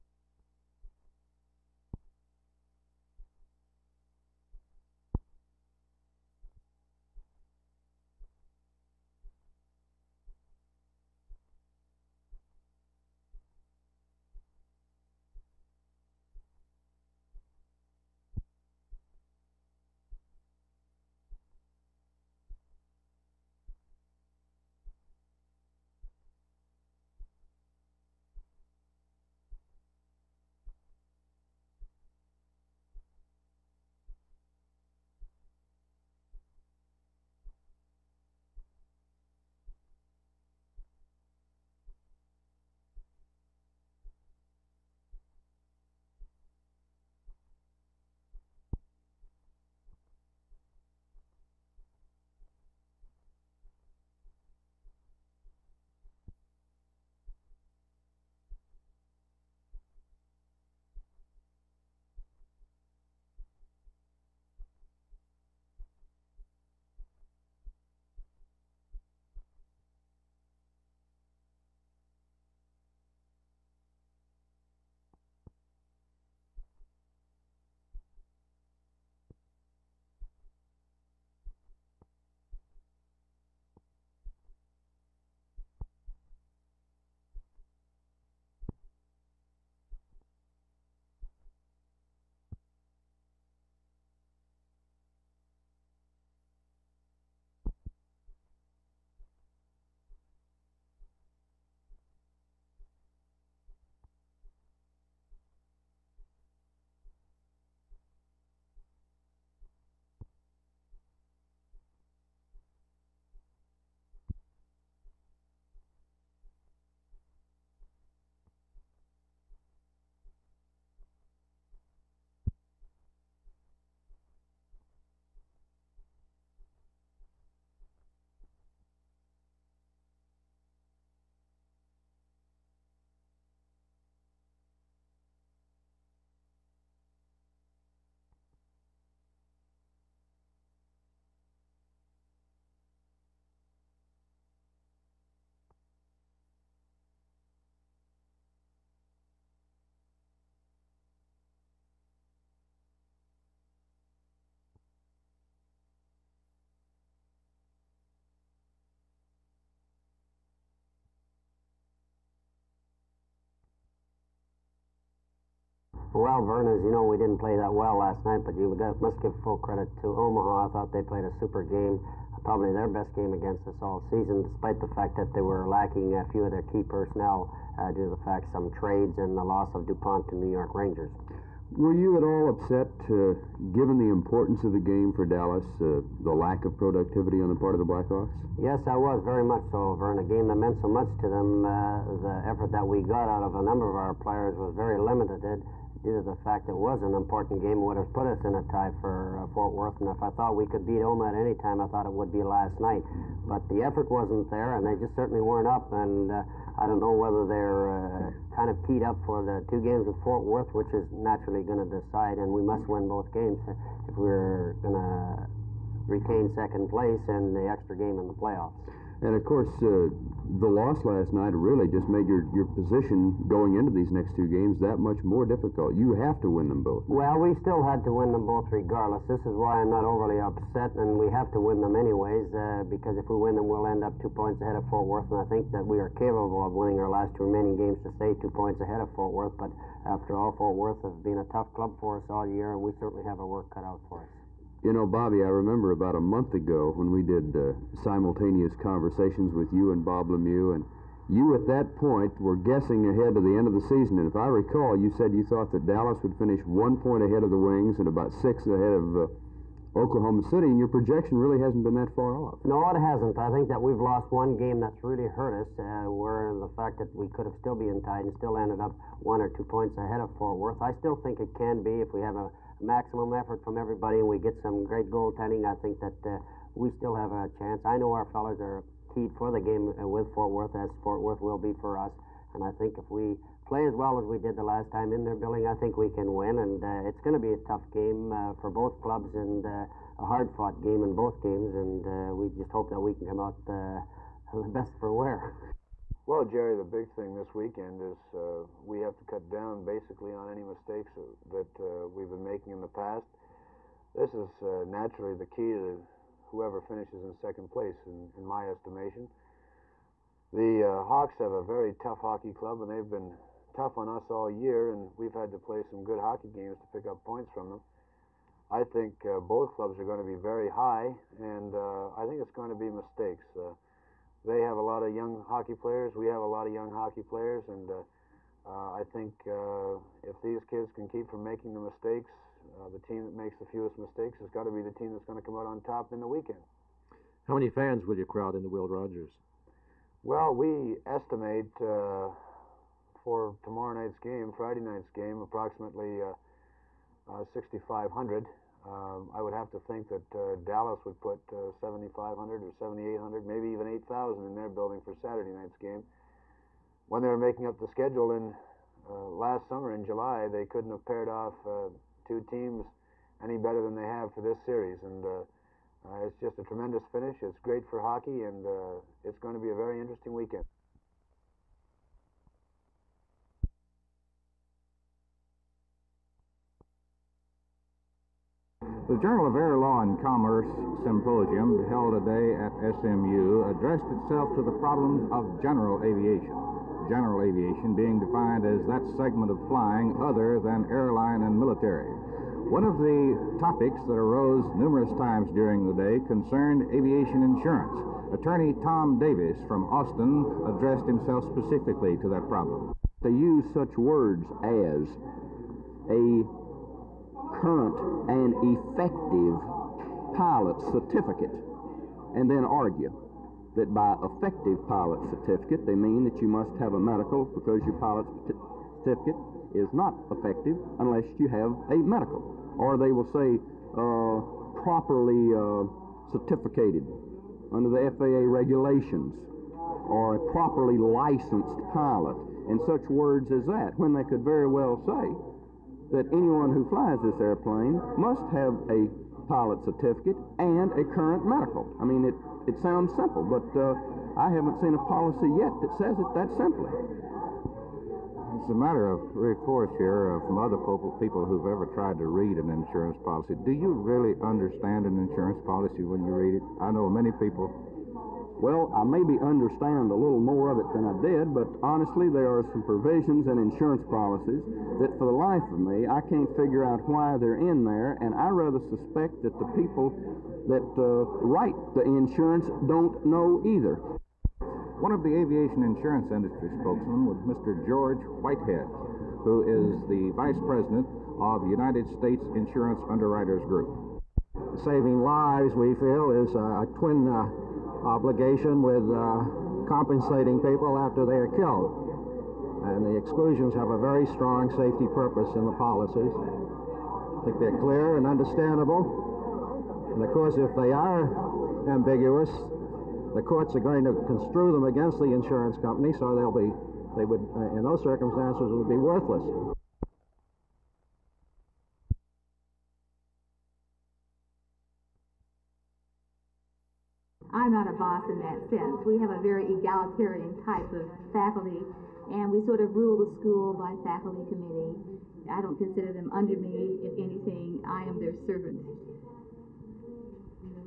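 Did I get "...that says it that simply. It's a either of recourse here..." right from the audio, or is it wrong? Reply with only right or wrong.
wrong.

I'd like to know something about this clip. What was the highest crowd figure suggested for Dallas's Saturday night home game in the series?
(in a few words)
8,000.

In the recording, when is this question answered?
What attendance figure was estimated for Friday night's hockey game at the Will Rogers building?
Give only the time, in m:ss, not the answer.
5:47.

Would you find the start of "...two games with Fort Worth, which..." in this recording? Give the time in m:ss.
3:29.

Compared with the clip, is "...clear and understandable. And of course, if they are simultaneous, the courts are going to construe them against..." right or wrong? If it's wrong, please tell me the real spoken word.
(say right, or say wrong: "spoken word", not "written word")
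wrong: "ambiguous", not "simultaneous".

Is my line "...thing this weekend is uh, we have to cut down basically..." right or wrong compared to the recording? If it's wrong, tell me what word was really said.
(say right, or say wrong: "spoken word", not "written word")
right.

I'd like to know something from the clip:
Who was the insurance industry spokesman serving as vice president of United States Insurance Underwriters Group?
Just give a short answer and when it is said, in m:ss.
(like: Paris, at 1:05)
George Whitehead, at 7:57.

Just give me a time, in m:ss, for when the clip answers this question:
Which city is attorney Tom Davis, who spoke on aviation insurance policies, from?
6:39.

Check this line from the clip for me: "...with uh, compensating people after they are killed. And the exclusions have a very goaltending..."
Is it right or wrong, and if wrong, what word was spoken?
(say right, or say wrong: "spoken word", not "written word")
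wrong: "strong", not "goaltending".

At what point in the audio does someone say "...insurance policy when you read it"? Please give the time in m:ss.
7:35.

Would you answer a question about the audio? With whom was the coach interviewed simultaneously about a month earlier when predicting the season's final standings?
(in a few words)
Bob Lemieux.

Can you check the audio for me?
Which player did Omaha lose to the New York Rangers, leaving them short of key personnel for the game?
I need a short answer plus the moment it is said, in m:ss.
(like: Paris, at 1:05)
DuPont, at 2:59.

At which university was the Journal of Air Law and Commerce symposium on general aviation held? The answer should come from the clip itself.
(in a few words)
SMU.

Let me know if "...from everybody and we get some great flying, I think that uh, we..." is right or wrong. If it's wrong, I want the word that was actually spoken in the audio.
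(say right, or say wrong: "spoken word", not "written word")
wrong: "goaltending", not "flying".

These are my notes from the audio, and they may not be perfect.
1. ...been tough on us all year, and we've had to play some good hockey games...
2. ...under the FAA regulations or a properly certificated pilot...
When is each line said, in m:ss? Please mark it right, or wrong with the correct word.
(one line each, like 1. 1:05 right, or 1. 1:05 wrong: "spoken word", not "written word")
1. 5:13 right
2. 7:07 wrong: "licensed", not "certificated".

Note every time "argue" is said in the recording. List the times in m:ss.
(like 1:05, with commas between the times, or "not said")
6:52.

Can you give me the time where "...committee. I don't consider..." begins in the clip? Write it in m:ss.
8:44.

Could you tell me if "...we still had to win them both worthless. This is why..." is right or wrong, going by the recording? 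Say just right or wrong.
wrong.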